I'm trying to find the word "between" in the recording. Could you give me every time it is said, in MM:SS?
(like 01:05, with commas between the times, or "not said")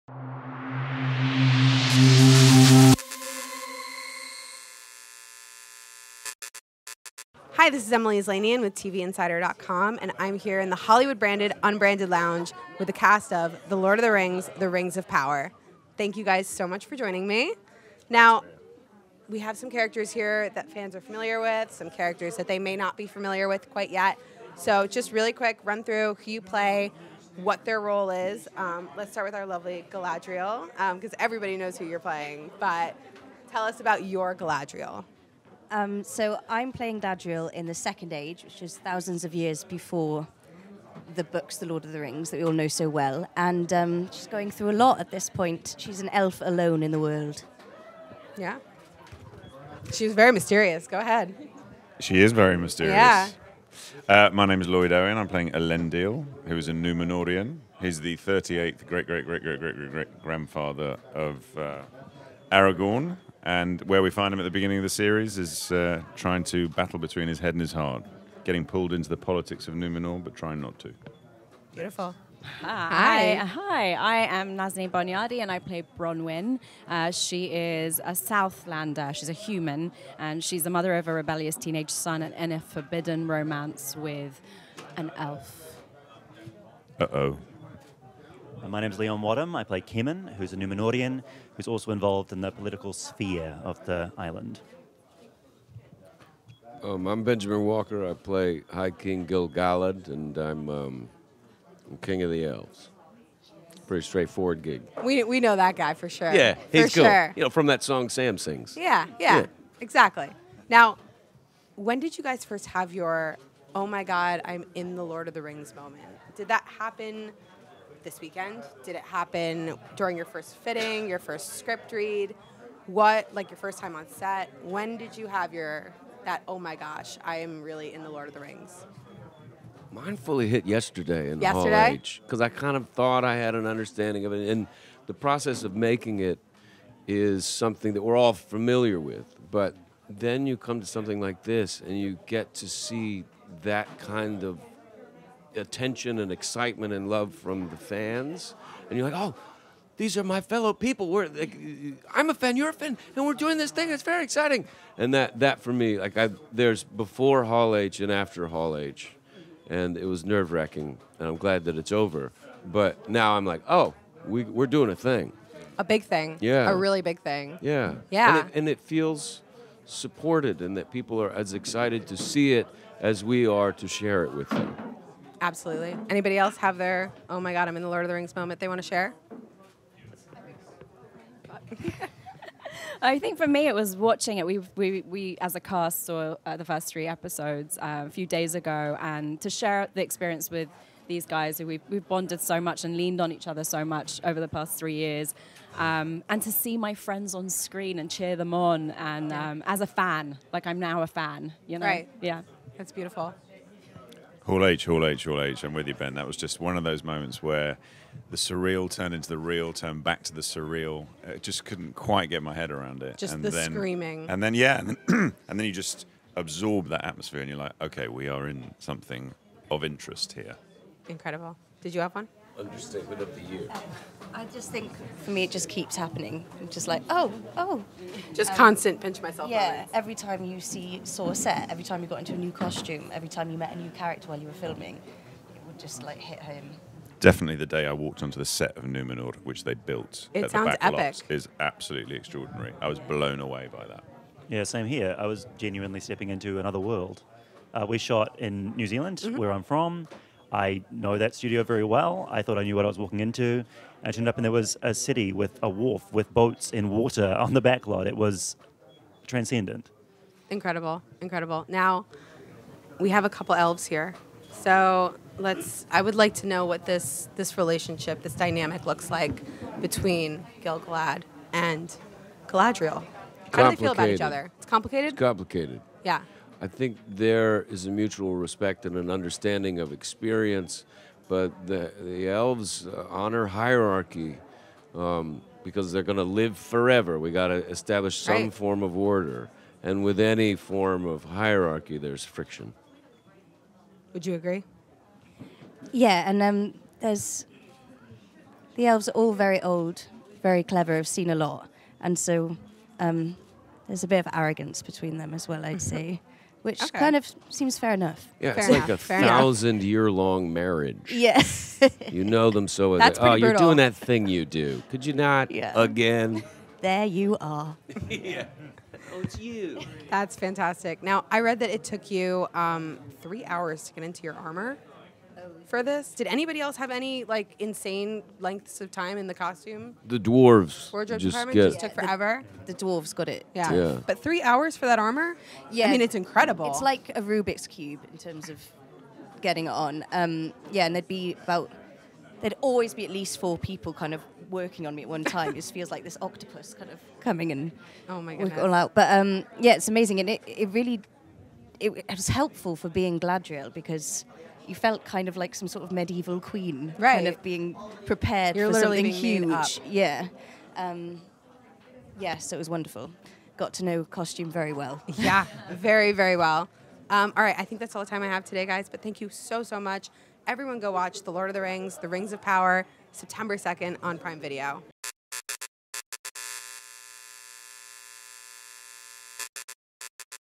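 01:06, 04:29, 05:04.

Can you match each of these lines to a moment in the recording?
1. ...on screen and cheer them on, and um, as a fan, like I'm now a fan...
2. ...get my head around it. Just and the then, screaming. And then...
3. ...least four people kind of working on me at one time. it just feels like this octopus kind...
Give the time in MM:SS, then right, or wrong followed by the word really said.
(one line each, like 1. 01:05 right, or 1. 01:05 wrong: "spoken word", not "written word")
1. 03:17 right
2. 03:32 right
3. 05:43 right.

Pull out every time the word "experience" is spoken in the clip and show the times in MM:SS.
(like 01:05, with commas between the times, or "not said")
03:10, 04:39.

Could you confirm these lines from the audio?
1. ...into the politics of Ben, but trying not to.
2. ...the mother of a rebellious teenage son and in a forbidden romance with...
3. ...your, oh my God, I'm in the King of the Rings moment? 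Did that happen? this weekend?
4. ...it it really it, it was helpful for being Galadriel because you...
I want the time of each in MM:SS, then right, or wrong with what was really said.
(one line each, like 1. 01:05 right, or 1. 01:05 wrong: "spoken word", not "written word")
1. 01:08 wrong: "Numenor", not "Ben"
2. 01:20 right
3. 01:52 wrong: "Lord", not "King"
4. 05:50 right.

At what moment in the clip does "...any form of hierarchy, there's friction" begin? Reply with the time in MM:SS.
04:50.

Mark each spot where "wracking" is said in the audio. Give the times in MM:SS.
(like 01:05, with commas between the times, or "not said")
02:40.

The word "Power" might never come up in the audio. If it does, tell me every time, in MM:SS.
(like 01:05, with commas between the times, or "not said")
00:15, 06:12.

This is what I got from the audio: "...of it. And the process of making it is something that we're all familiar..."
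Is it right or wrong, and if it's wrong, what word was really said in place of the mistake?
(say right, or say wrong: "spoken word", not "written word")
right.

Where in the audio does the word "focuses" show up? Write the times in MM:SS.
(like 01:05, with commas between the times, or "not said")
not said.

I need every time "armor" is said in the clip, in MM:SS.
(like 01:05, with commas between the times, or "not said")
05:24, 05:34.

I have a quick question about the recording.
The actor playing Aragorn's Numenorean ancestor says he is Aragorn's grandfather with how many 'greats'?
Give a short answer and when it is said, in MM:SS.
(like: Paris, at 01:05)
38th, at 00:58.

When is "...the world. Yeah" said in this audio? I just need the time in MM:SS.
00:46.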